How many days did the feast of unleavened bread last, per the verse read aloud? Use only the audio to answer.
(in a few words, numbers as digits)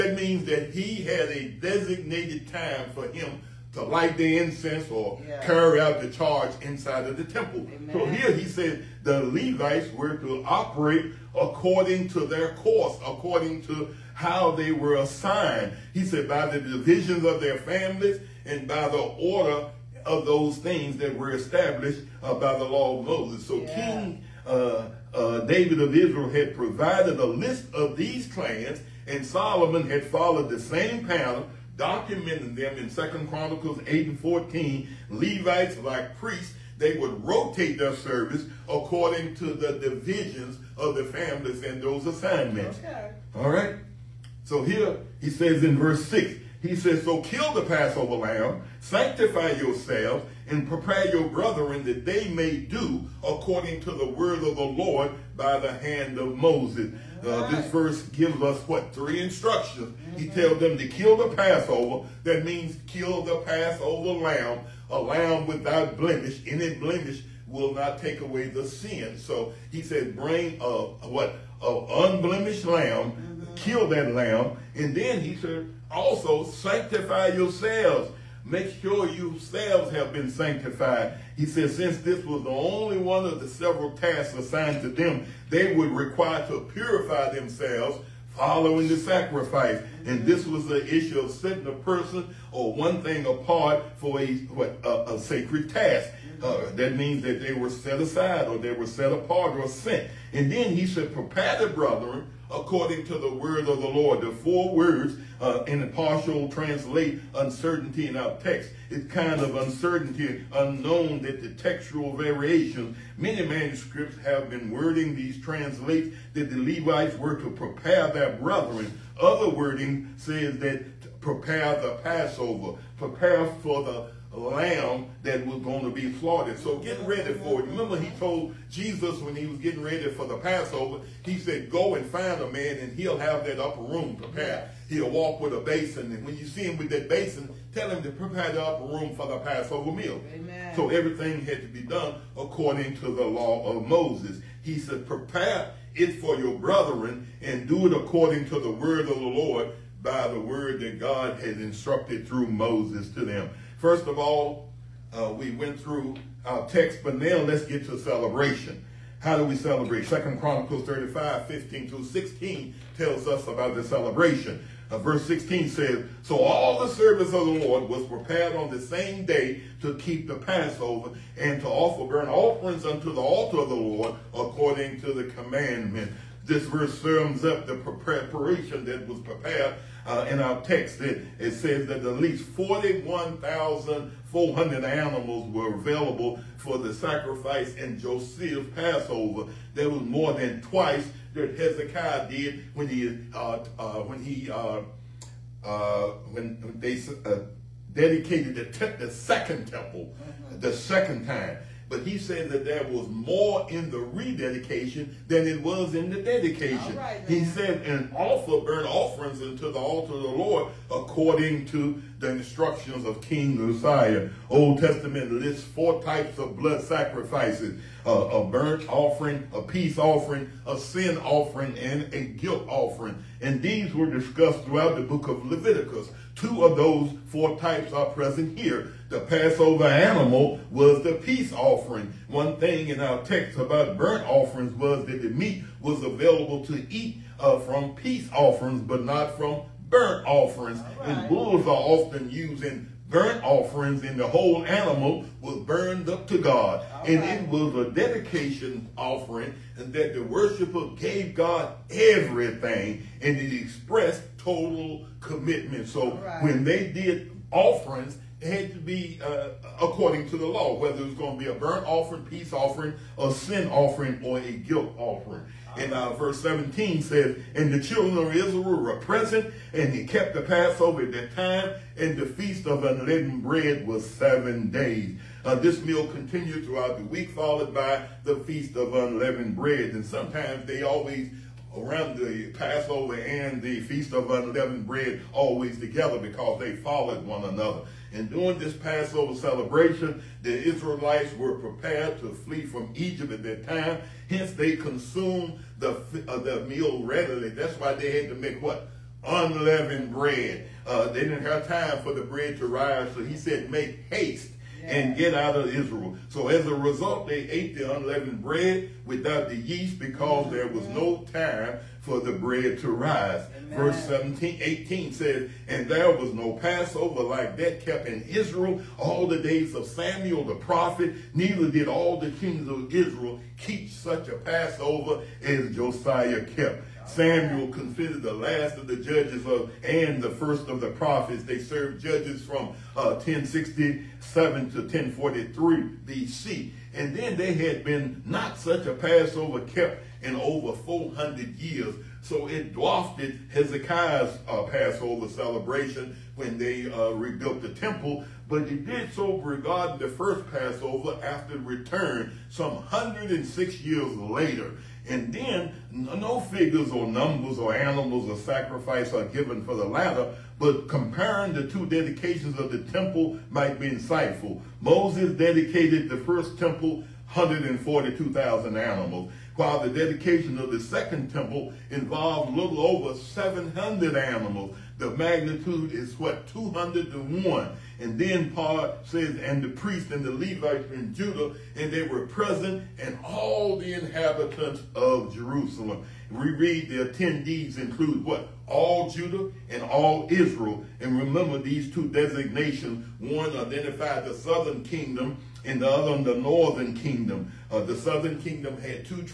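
7.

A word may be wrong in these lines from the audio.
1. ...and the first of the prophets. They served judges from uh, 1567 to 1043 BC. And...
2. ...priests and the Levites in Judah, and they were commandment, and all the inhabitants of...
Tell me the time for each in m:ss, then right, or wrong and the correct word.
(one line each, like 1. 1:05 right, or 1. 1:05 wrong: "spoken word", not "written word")
1. 5:29 wrong: "1067", not "1567"
2. 6:19 wrong: "present", not "commandment".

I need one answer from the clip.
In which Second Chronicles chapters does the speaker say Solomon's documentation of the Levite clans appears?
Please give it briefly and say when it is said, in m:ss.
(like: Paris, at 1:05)
8 and 14, at 0:33.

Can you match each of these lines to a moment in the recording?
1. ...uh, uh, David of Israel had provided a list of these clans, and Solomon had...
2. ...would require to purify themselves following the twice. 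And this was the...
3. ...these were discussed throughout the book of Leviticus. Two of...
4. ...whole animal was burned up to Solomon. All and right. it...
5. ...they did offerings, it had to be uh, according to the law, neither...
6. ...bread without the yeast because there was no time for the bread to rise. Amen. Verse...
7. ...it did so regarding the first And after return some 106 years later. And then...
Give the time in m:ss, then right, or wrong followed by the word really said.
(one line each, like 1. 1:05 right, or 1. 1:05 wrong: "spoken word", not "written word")
1. 0:24 right
2. 1:25 wrong: "sacrifice", not "twice"
3. 3:43 right
4. 4:04 wrong: "God", not "Solomon"
5. 4:16 wrong: "whether", not "neither"
6. 5:08 right
7. 5:48 wrong: "Passover", not "And".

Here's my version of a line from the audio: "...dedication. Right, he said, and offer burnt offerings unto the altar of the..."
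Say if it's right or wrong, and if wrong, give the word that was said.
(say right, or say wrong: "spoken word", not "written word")
right.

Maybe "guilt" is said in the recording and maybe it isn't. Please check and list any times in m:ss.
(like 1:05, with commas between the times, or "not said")
3:42, 4:24.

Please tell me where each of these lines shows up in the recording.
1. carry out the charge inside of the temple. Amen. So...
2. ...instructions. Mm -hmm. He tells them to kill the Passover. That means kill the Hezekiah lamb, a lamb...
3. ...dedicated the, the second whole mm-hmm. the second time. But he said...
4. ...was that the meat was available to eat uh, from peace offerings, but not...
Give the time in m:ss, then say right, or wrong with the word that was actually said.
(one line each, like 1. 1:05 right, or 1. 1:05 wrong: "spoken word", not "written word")
1. 0:05 right
2. 0:59 wrong: "Passover", not "Hezekiah"
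3. 3:17 wrong: "temple", not "whole"
4. 3:54 right.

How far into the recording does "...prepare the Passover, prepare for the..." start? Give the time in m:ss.
2:01.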